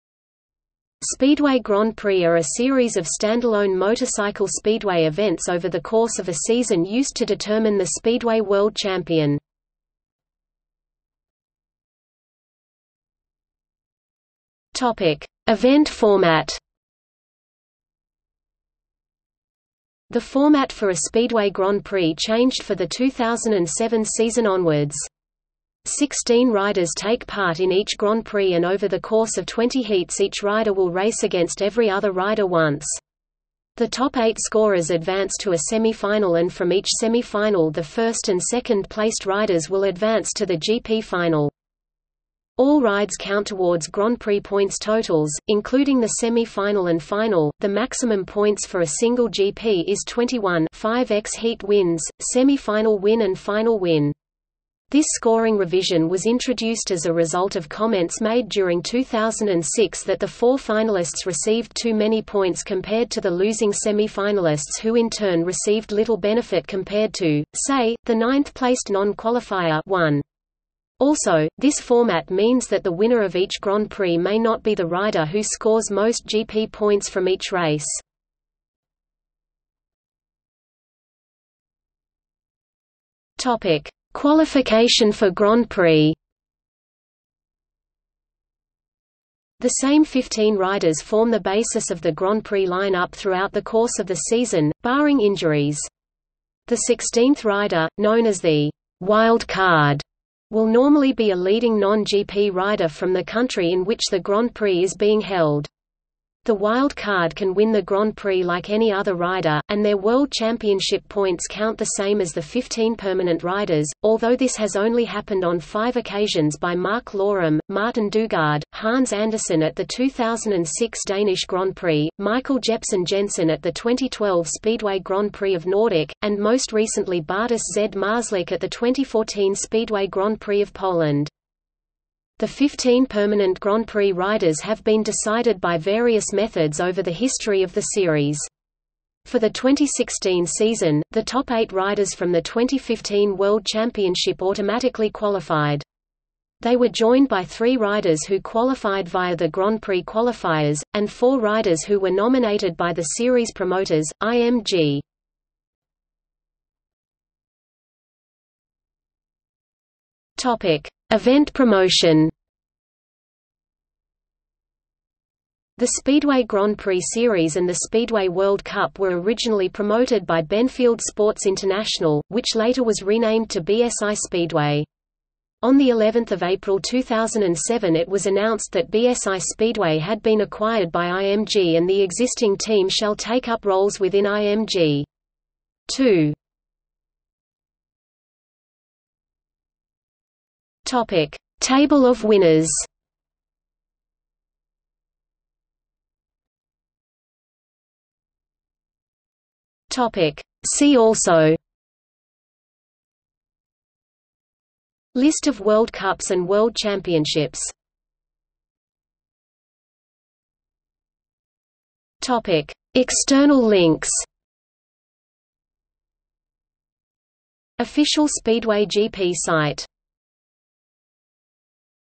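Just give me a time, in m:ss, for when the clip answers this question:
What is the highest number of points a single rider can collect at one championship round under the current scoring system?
0:50.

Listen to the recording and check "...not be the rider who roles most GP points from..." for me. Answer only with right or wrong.
wrong.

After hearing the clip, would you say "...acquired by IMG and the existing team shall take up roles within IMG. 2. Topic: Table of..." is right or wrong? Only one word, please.
right.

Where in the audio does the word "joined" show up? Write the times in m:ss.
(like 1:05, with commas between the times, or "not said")
2:26.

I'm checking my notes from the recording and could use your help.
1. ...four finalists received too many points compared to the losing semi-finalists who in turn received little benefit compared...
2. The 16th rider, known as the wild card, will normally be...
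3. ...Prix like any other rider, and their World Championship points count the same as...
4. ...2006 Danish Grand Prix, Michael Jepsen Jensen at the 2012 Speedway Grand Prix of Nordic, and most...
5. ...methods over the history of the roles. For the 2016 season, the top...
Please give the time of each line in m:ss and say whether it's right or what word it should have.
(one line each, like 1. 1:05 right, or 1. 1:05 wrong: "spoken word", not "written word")
1. 1:00 right
2. 1:36 right
3. 1:48 right
4. 1:59 right
5. 2:16 wrong: "series", not "roles".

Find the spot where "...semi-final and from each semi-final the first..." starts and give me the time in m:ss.
0:35.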